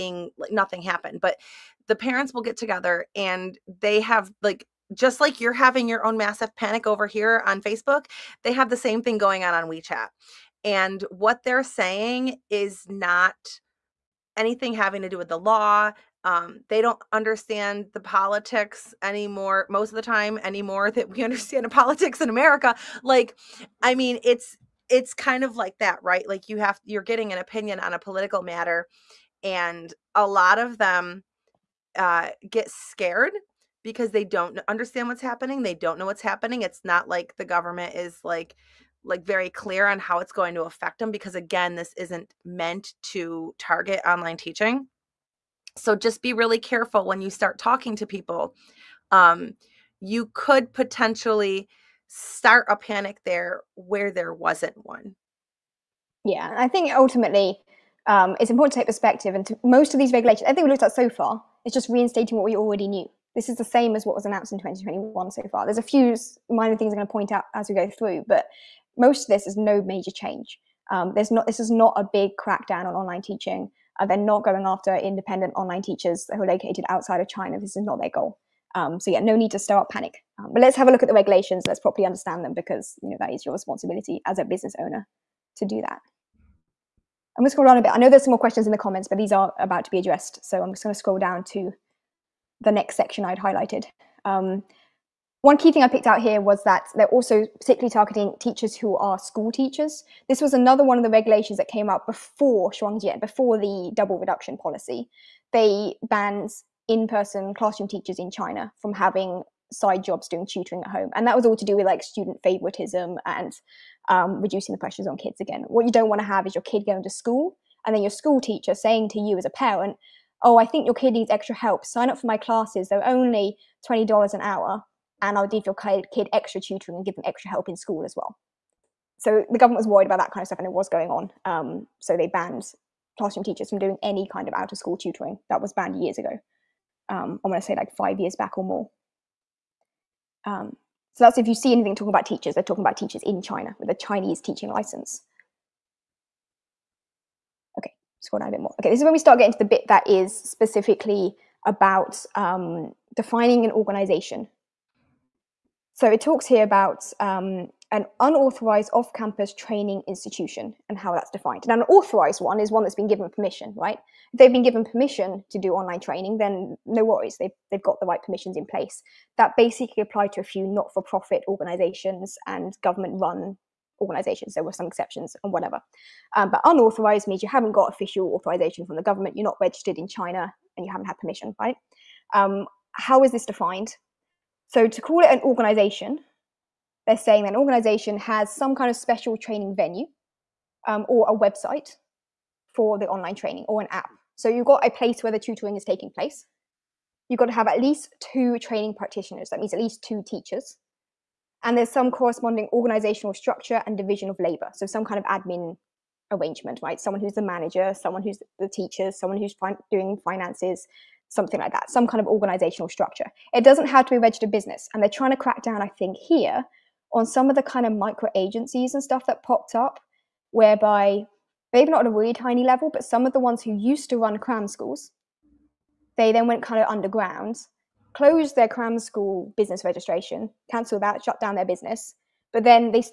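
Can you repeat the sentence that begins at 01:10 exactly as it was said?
Um, there's not this is not a big crackdown on online teaching.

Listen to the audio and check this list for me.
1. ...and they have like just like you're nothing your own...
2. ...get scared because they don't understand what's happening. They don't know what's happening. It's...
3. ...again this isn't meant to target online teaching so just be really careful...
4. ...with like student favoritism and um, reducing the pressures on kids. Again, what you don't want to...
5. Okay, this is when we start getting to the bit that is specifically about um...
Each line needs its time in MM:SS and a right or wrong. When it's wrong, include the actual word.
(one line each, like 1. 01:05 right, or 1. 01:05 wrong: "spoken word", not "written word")
1. 00:03 wrong: "having", not "nothing"
2. 00:32 right
3. 00:41 right
4. 01:51 right
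5. 02:28 right.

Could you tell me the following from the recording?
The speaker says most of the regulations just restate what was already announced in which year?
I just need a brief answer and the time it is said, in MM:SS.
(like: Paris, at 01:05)
2021, at 01:04.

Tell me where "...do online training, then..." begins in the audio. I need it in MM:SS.
02:45.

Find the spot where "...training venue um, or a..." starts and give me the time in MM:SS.
03:09.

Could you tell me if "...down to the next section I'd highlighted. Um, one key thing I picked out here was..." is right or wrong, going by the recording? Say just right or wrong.
right.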